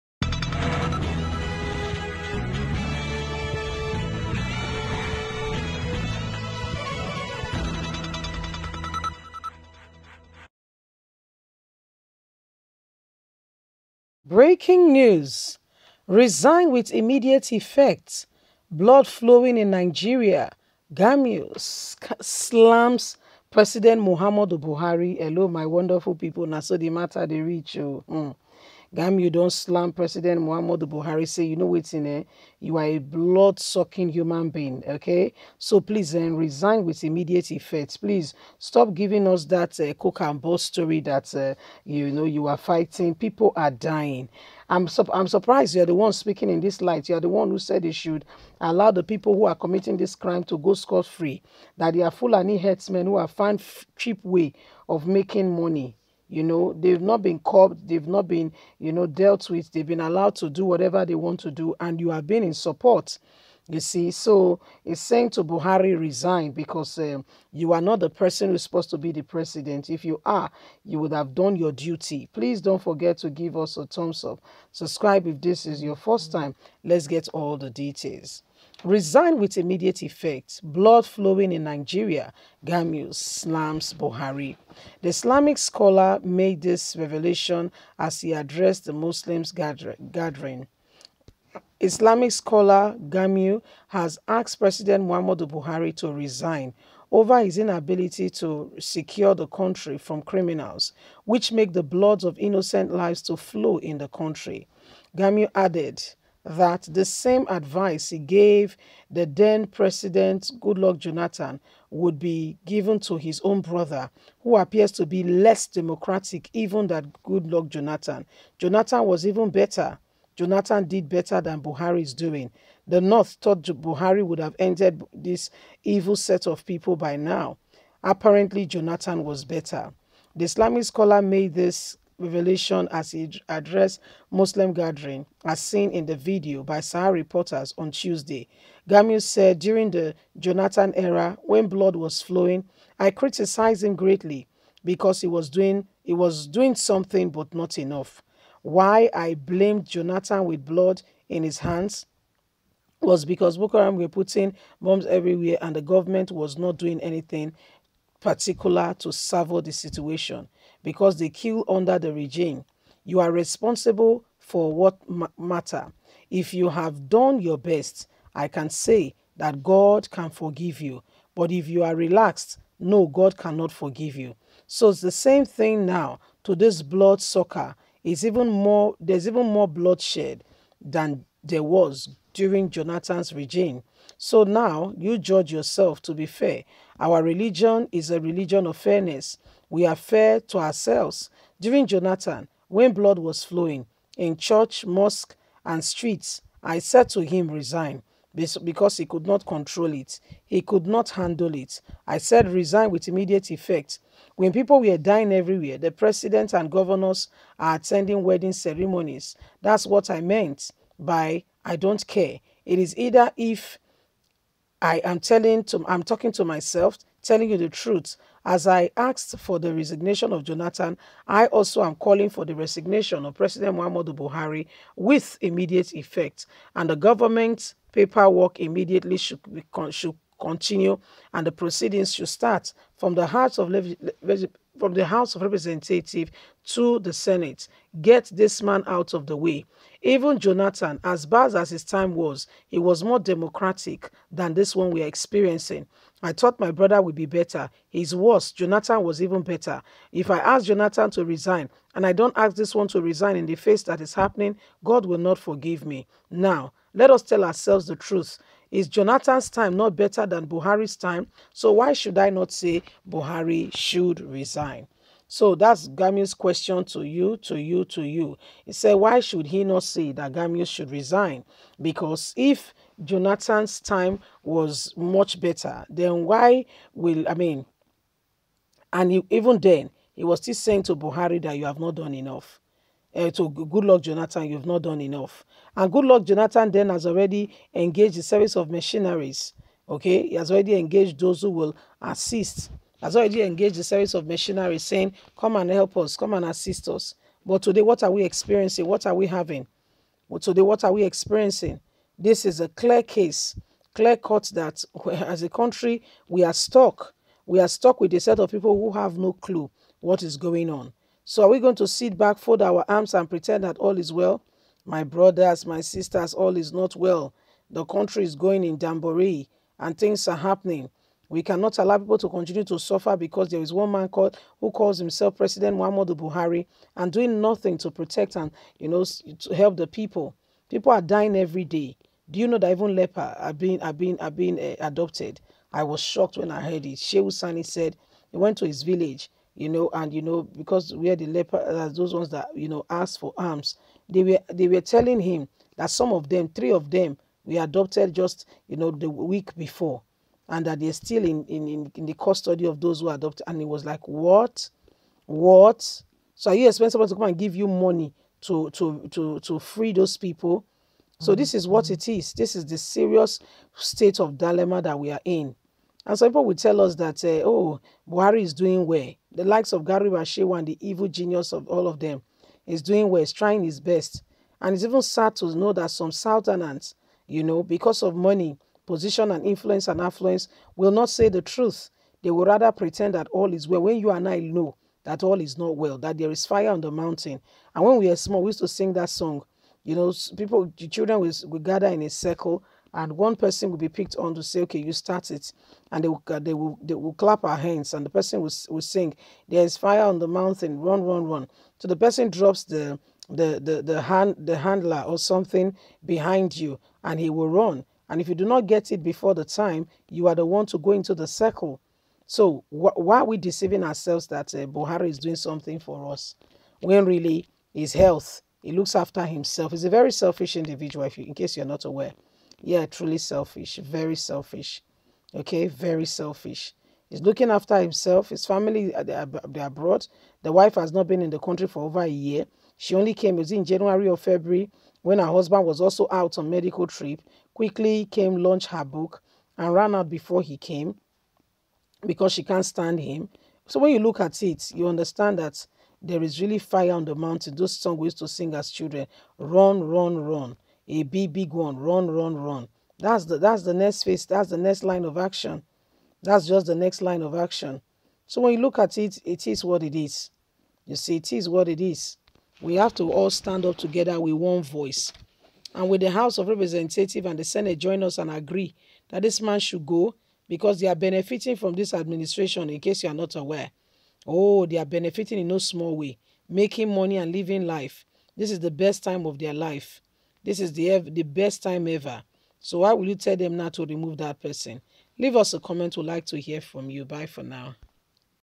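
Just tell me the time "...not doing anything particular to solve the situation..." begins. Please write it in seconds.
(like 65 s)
156 s.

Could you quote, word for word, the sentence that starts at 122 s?
The North thought Buhari would have ended this evil set of people by now.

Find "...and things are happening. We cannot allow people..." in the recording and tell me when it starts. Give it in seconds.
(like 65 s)
319 s.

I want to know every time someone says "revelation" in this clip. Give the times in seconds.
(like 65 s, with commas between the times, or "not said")
86 s, 132 s.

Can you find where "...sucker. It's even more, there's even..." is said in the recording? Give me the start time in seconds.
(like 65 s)
177 s.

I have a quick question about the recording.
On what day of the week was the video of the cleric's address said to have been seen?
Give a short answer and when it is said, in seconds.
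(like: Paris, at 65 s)
Tuesday, at 137 s.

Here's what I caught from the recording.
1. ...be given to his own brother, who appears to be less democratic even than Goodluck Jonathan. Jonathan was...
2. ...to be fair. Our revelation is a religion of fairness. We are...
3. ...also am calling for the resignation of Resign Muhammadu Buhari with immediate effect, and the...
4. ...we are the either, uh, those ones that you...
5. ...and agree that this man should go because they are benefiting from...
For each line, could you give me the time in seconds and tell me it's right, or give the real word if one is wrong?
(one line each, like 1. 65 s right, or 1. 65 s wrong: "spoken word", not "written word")
1. 112 s right
2. 186 s wrong: "religion", not "revelation"
3. 221 s wrong: "President", not "Resign"
4. 340 s wrong: "leper", not "either"
5. 468 s right.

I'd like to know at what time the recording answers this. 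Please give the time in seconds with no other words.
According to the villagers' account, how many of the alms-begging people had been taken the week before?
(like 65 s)
346 s.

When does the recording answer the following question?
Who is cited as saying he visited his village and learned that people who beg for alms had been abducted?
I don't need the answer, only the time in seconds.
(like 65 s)
336 s.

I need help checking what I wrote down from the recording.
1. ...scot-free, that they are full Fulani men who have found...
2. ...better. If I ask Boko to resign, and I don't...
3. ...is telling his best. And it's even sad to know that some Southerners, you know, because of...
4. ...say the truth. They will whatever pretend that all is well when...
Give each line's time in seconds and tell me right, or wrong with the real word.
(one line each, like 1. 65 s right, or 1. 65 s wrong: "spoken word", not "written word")
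1. 50 s right
2. 249 s wrong: "Jonathan", not "Boko"
3. 373 s wrong: "trying", not "telling"
4. 381 s wrong: "rather", not "whatever".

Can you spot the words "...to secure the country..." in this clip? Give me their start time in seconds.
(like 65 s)
98 s.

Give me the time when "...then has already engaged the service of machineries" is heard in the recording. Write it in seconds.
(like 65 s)
286 s.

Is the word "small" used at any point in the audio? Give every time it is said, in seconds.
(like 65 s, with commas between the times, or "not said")
388 s, 475 s.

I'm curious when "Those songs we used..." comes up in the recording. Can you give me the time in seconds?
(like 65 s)
447 s.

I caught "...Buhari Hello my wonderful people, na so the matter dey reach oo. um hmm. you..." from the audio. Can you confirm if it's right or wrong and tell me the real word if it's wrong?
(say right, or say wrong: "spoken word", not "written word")
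right.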